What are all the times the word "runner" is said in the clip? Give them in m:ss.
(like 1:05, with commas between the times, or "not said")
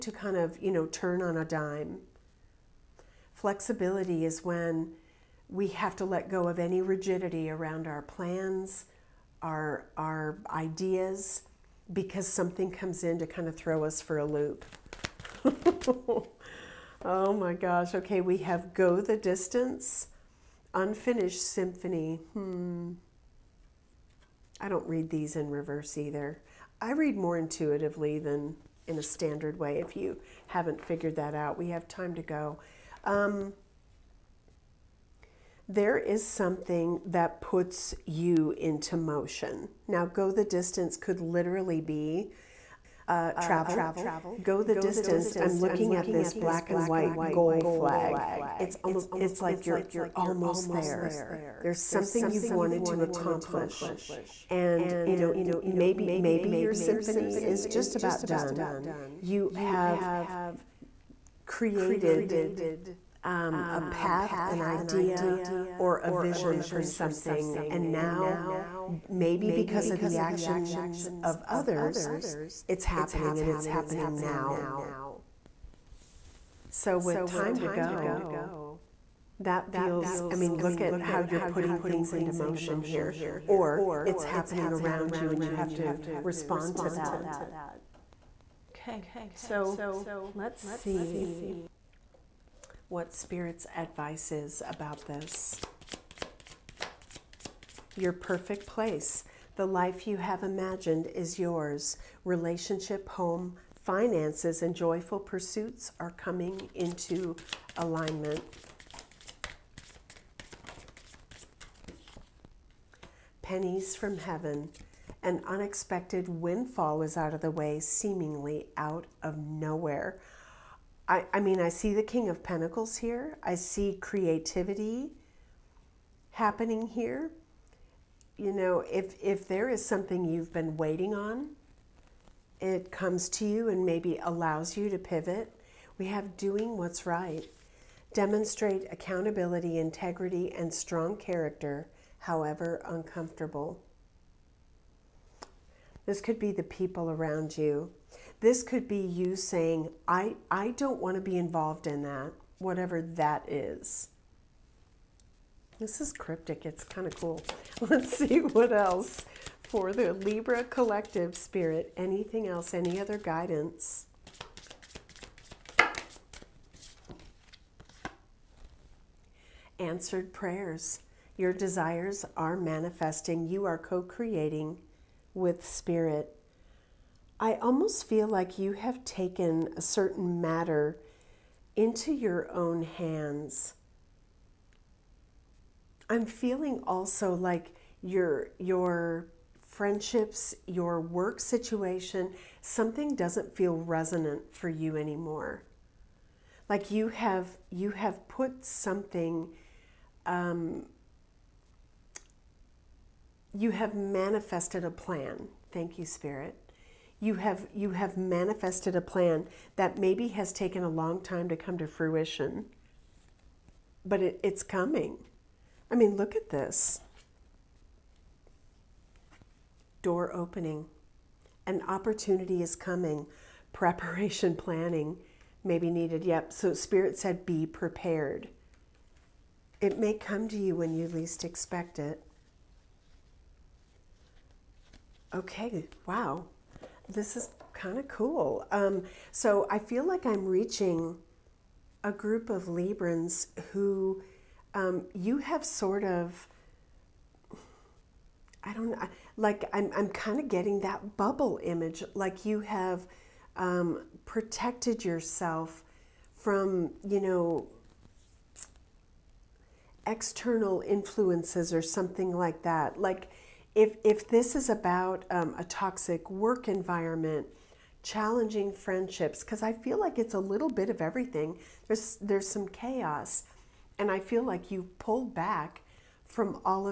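not said.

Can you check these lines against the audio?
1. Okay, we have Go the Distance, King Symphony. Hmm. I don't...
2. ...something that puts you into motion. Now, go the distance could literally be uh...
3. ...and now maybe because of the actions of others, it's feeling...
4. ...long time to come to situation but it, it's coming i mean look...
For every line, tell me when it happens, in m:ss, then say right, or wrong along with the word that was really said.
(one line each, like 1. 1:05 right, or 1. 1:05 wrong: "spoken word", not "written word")
1. 0:17 wrong: "Unfinished", not "King"
2. 0:36 right
3. 1:07 wrong: "happening", not "feeling"
4. 3:30 wrong: "fruition", not "situation".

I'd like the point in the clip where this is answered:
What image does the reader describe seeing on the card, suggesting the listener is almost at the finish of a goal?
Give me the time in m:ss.
0:46.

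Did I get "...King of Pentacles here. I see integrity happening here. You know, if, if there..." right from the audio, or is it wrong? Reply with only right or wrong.
wrong.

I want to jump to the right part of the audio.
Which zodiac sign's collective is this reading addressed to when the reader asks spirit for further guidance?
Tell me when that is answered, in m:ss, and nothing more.
2:40.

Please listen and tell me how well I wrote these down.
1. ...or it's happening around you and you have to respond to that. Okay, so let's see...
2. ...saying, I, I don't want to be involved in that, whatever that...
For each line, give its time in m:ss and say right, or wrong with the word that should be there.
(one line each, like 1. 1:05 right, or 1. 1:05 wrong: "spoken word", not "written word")
1. 1:23 right
2. 2:29 right.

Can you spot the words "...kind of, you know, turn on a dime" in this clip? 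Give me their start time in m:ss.
0:00.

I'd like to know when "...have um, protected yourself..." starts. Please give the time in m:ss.
4:12.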